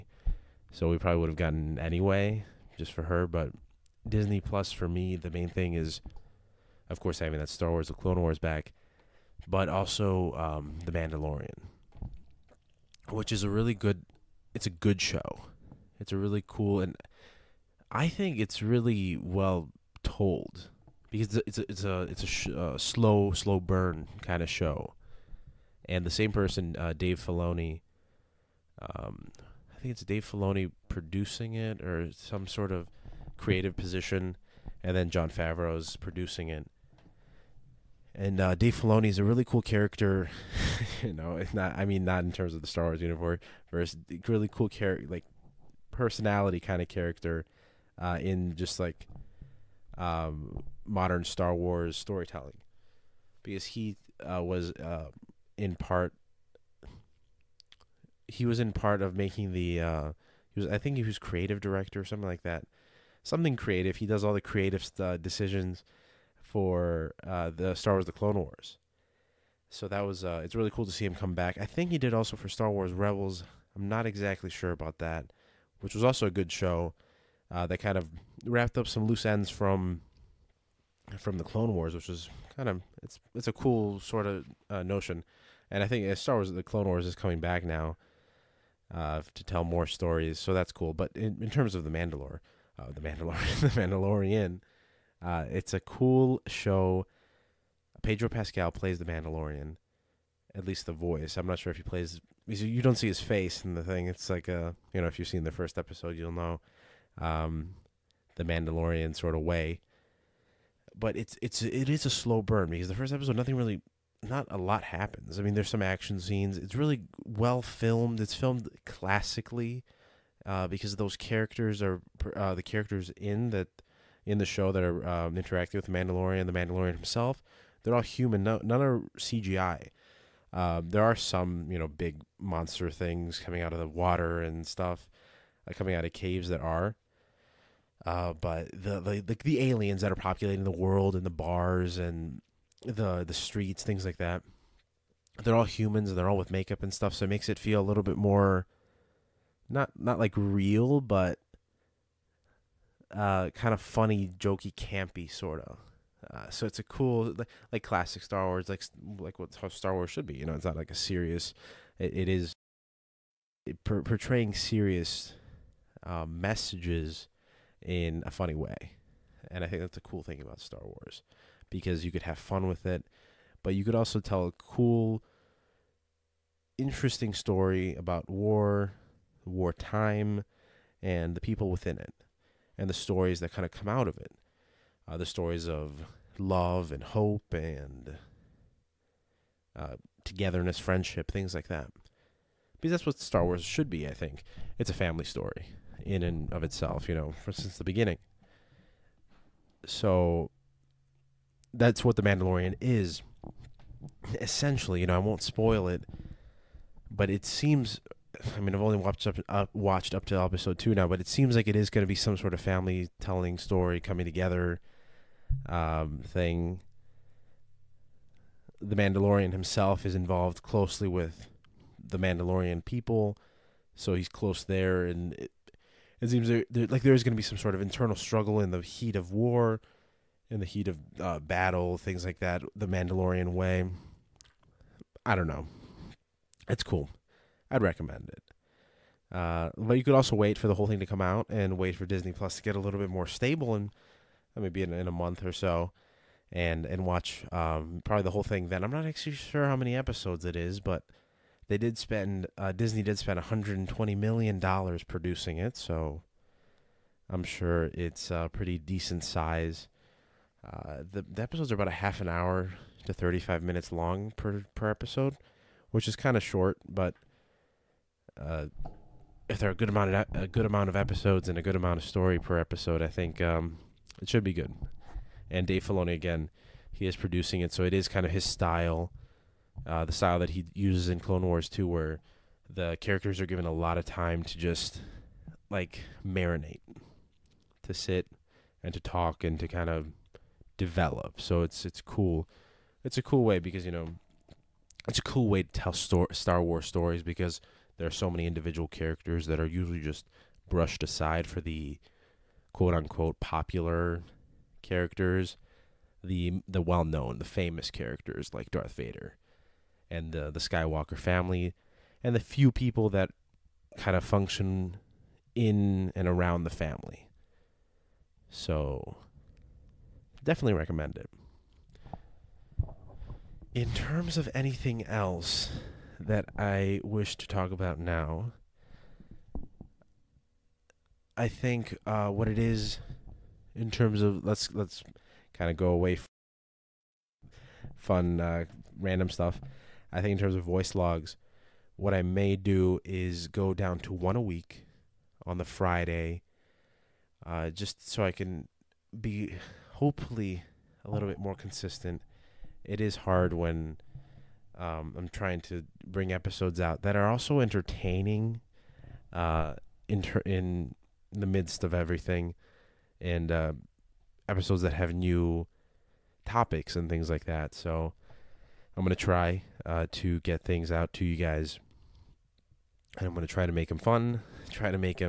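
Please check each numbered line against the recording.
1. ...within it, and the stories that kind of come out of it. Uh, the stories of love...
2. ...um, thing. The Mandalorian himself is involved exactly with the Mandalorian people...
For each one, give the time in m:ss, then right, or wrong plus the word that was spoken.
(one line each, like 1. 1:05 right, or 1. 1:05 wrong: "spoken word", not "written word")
1. 3:01 right
2. 3:35 wrong: "closely", not "exactly".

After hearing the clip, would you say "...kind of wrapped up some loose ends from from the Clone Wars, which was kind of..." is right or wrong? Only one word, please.
right.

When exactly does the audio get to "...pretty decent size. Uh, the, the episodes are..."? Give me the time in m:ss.
4:18.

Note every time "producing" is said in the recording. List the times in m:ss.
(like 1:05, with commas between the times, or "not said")
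0:30, 0:35, 4:15, 4:37.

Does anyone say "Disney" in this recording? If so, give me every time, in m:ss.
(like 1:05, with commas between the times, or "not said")
0:04, 4:02, 4:12.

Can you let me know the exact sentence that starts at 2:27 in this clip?
So it makes it feel a little bit more, not not like real, but uh, kind of funny, jokey, campy sort of.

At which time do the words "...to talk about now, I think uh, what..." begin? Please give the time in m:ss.
5:27.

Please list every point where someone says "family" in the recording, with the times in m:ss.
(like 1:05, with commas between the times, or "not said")
3:14, 3:32, 5:11, 5:16.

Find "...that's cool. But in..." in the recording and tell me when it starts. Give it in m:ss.
1:30.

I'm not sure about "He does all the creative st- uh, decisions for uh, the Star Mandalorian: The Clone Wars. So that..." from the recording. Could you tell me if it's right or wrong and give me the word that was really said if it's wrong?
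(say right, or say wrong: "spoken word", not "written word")
wrong: "Wars", not "Mandalorian".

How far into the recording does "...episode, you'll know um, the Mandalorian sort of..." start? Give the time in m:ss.
1:45.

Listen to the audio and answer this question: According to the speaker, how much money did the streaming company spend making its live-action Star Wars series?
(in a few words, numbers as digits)
$120 million.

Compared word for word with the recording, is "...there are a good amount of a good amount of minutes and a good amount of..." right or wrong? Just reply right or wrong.
wrong.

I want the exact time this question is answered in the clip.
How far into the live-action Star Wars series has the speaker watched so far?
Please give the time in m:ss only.
3:30.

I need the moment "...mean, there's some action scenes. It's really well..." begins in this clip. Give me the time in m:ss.
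1:55.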